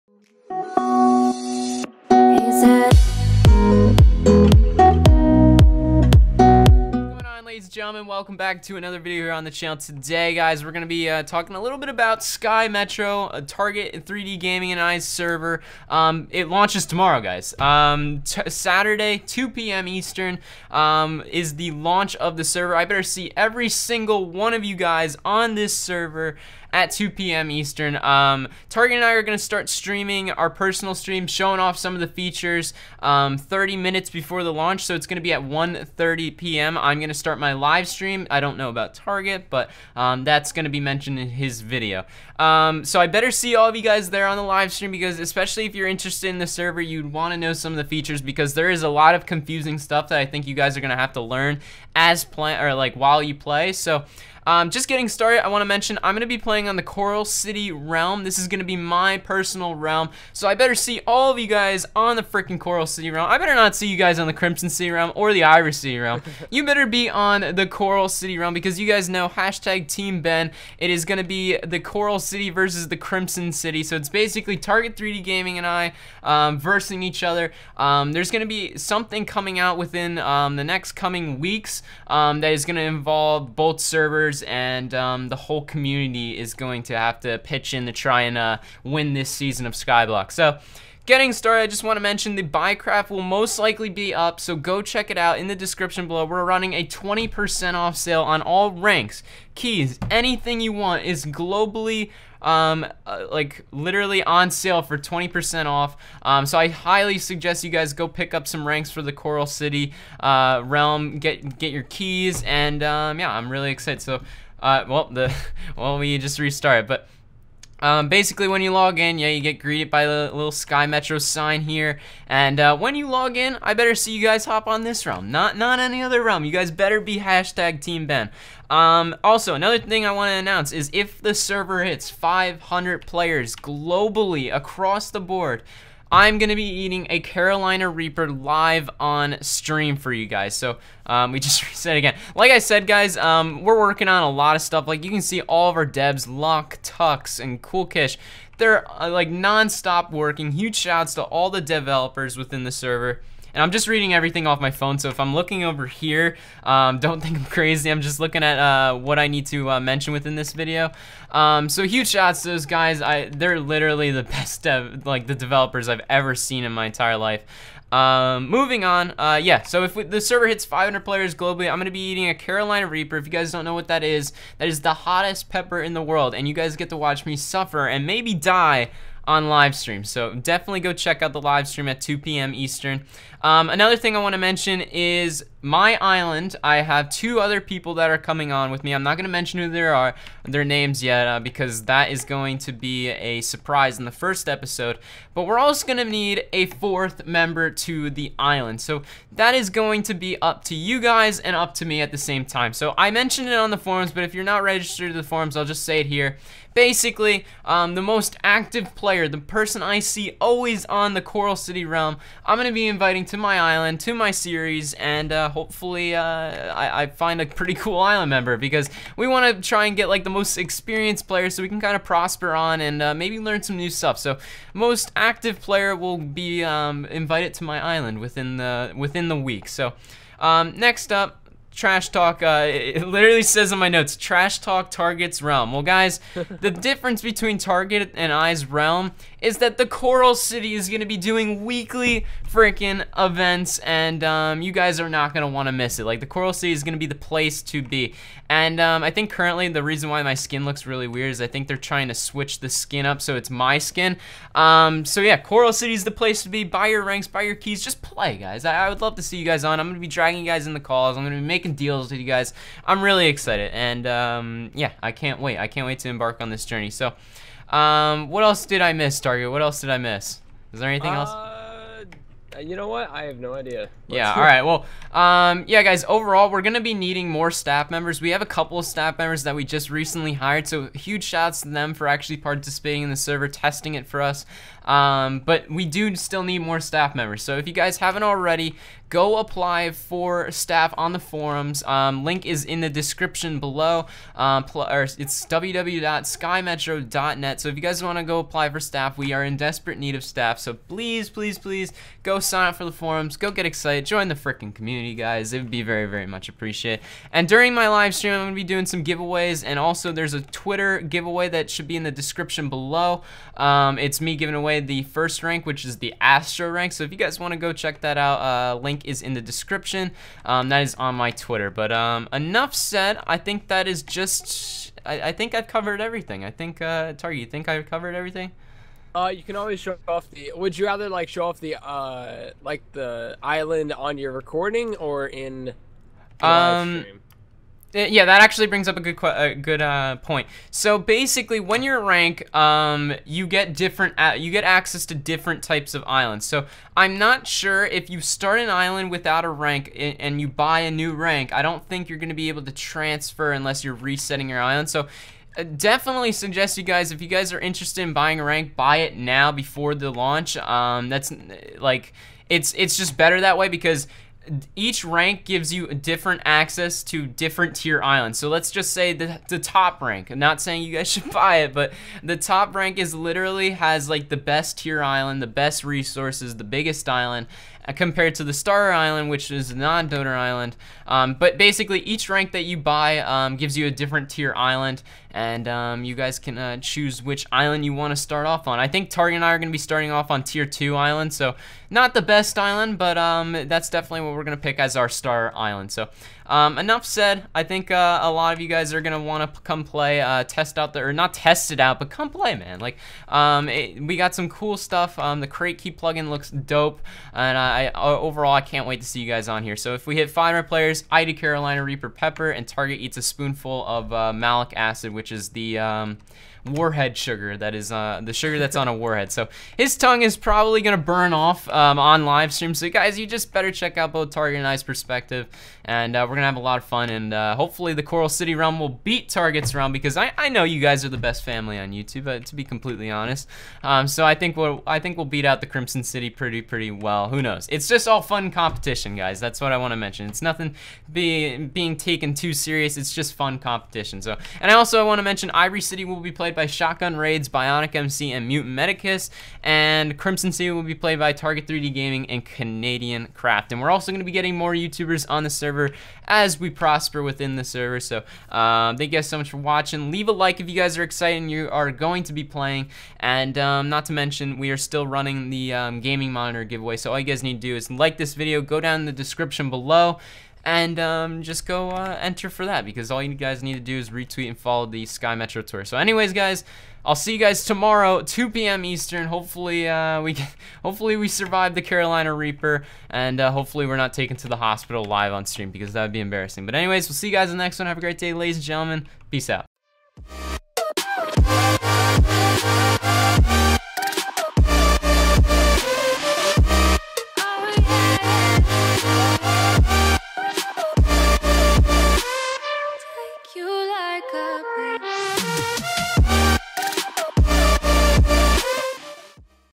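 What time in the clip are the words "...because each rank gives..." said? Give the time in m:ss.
6:03.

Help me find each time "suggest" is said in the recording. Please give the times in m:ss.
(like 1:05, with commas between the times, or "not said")
1:47, 5:56.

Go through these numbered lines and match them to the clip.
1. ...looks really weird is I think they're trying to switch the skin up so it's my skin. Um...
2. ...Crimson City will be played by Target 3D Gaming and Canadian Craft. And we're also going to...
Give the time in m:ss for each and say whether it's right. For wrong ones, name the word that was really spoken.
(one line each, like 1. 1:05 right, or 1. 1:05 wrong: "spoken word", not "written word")
1. 4:10 right
2. 7:30 right.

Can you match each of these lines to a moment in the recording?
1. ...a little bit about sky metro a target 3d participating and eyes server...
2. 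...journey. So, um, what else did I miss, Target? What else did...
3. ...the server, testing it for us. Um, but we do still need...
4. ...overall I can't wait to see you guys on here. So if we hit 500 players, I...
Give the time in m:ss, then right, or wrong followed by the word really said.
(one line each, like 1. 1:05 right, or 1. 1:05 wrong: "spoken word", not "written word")
1. 0:11 wrong: "gaming", not "participating"
2. 4:26 right
3. 4:43 right
4. 6:48 right.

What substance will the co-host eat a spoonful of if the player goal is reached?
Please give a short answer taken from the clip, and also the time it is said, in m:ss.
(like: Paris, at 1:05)
Malic acid, at 6:54.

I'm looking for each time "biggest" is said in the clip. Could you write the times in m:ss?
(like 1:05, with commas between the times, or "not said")
6:16.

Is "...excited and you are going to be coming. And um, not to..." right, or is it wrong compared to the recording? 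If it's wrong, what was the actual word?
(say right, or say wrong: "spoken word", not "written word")
wrong: "playing", not "coming".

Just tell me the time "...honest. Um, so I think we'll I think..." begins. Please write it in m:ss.
7:13.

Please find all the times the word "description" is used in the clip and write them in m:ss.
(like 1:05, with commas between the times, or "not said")
1:35, 4:52, 5:12, 5:19, 7:49.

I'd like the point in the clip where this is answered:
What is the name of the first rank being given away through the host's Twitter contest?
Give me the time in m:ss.
5:16.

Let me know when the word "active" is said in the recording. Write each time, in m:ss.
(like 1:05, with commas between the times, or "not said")
3:28, 3:45.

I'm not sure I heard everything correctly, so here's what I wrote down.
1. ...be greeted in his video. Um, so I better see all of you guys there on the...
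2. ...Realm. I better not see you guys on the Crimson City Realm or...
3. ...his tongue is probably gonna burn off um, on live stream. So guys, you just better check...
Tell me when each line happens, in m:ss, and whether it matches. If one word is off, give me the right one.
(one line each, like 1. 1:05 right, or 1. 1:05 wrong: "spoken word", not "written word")
1. 0:40 wrong: "mentioned", not "greeted"
2. 1:03 right
3. 6:59 right.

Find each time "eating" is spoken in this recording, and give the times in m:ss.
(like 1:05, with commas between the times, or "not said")
2:16, 2:52.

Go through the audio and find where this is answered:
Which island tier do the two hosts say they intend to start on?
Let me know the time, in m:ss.
6:30.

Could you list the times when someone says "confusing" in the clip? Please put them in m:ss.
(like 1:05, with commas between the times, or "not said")
0:49.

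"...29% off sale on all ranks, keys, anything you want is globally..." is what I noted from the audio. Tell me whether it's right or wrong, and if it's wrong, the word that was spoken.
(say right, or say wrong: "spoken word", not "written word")
wrong: "20", not "29".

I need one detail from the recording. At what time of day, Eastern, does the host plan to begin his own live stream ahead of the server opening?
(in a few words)
1:30 p.m.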